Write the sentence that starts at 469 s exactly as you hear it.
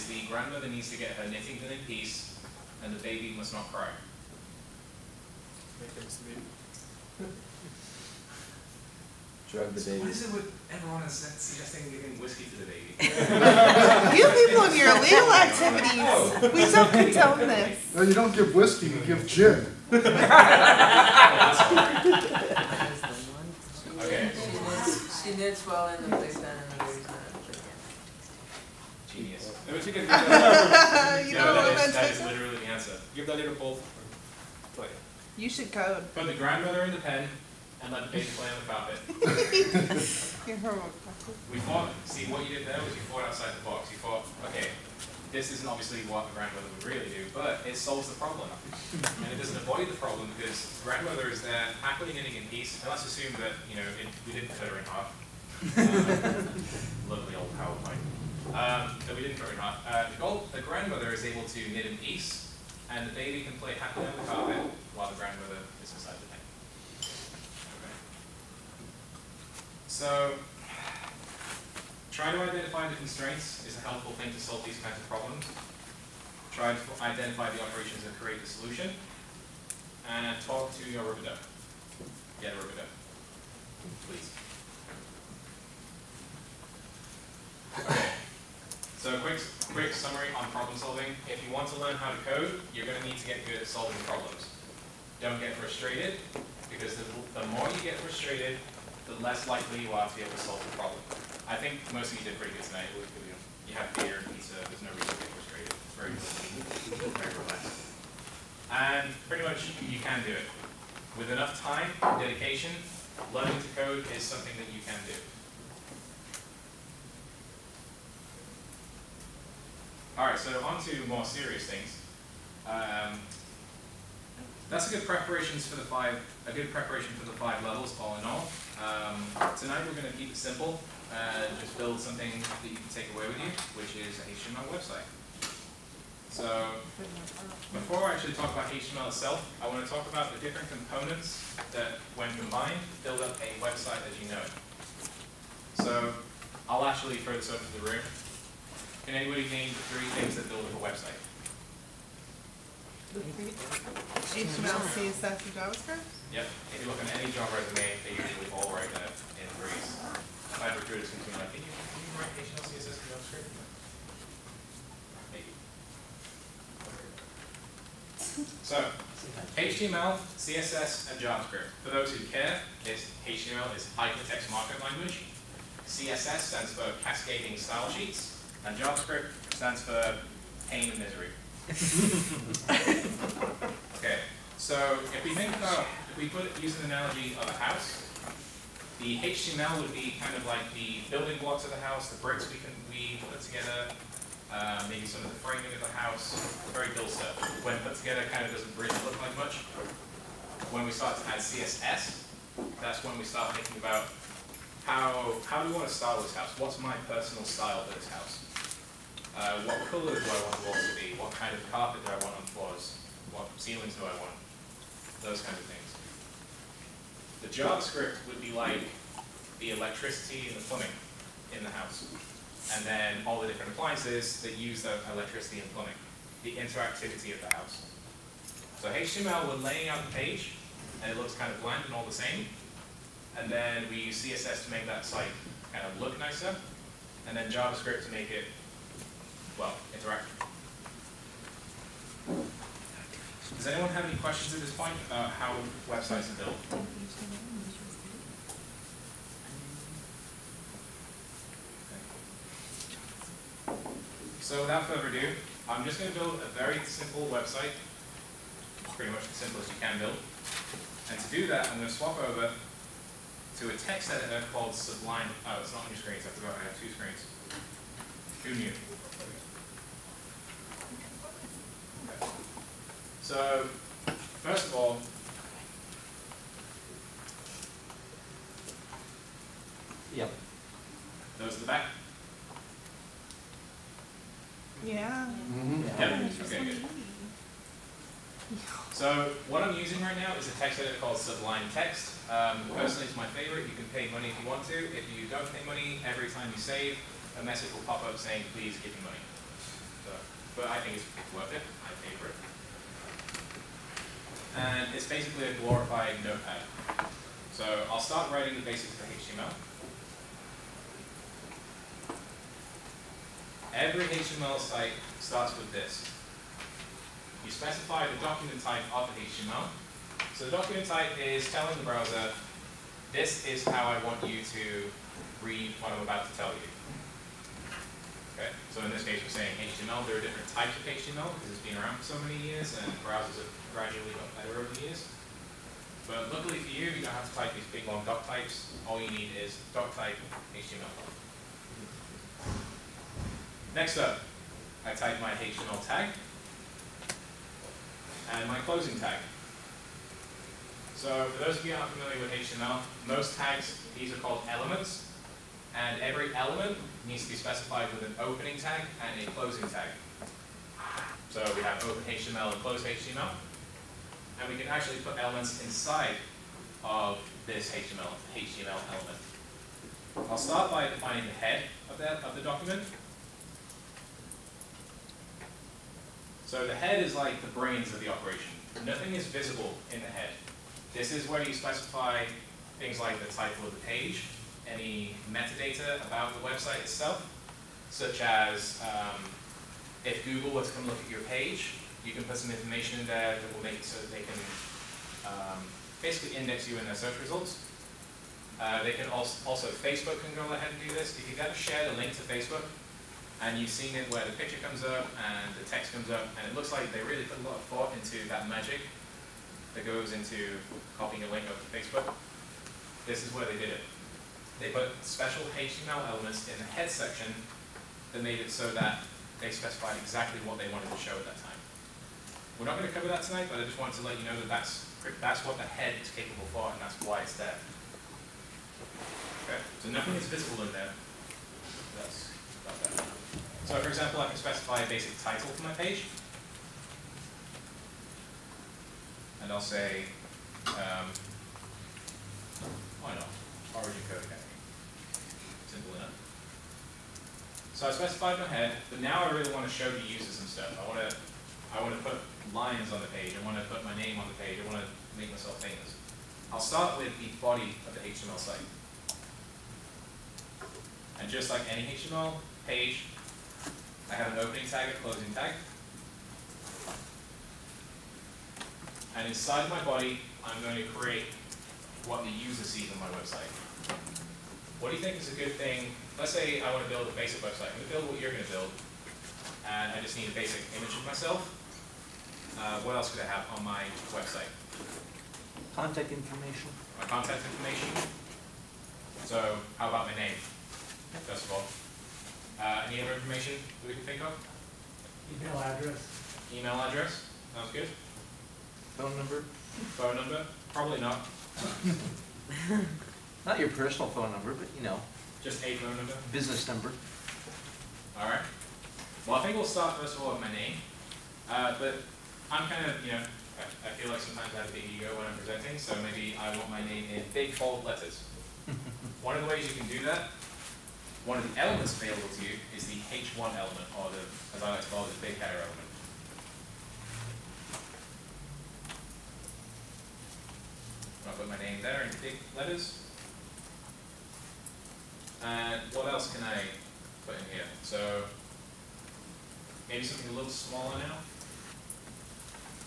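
And inside my body, I'm going to create what the user sees on my website.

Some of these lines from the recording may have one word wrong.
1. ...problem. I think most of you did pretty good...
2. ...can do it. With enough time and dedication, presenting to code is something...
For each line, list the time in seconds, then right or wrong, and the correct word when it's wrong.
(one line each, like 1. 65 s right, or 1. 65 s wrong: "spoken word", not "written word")
1. 100 s right
2. 109 s wrong: "learning", not "presenting".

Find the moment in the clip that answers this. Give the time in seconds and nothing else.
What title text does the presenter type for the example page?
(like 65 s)
443 s.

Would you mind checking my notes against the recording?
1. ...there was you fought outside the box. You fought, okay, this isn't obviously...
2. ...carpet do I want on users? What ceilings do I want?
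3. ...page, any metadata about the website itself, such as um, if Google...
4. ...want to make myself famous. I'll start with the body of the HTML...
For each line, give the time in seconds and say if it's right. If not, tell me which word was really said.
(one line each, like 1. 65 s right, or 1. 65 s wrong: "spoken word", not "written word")
1. 42 s right
2. 211 s wrong: "floors", not "users"
3. 383 s right
4. 454 s right.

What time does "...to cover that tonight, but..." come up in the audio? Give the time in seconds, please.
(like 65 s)
422 s.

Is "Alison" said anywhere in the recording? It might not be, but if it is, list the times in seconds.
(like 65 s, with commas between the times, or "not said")
not said.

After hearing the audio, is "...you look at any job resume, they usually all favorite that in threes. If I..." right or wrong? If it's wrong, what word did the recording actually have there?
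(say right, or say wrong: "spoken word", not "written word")
wrong: "write", not "favorite".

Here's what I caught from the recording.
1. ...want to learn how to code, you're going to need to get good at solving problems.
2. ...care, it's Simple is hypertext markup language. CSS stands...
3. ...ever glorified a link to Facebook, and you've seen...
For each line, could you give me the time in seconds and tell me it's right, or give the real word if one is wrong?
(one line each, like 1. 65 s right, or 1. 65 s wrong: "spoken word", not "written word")
1. 91 s right
2. 172 s wrong: "HTML", not "Simple"
3. 401 s wrong: "shared", not "glorified".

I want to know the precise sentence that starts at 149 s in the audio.
Can anybody name the three things that build up a website?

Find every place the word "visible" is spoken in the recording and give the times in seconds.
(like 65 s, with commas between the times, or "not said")
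379 s, 430 s.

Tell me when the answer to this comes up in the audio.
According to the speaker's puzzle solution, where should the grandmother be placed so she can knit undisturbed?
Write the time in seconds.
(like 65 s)
36 s.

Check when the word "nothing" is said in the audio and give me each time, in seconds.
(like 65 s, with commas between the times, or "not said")
378 s, 429 s.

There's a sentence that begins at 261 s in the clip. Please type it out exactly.
And to do that, I'm going to swap over to a text editor called Sublime.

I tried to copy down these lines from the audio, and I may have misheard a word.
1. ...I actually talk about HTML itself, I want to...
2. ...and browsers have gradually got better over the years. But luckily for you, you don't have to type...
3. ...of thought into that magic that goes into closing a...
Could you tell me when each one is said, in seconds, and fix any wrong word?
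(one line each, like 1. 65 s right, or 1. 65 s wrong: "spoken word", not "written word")
1. 138 s right
2. 332 s right
3. 407 s wrong: "copying", not "closing".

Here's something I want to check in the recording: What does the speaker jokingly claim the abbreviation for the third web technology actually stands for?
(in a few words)
pain and misery.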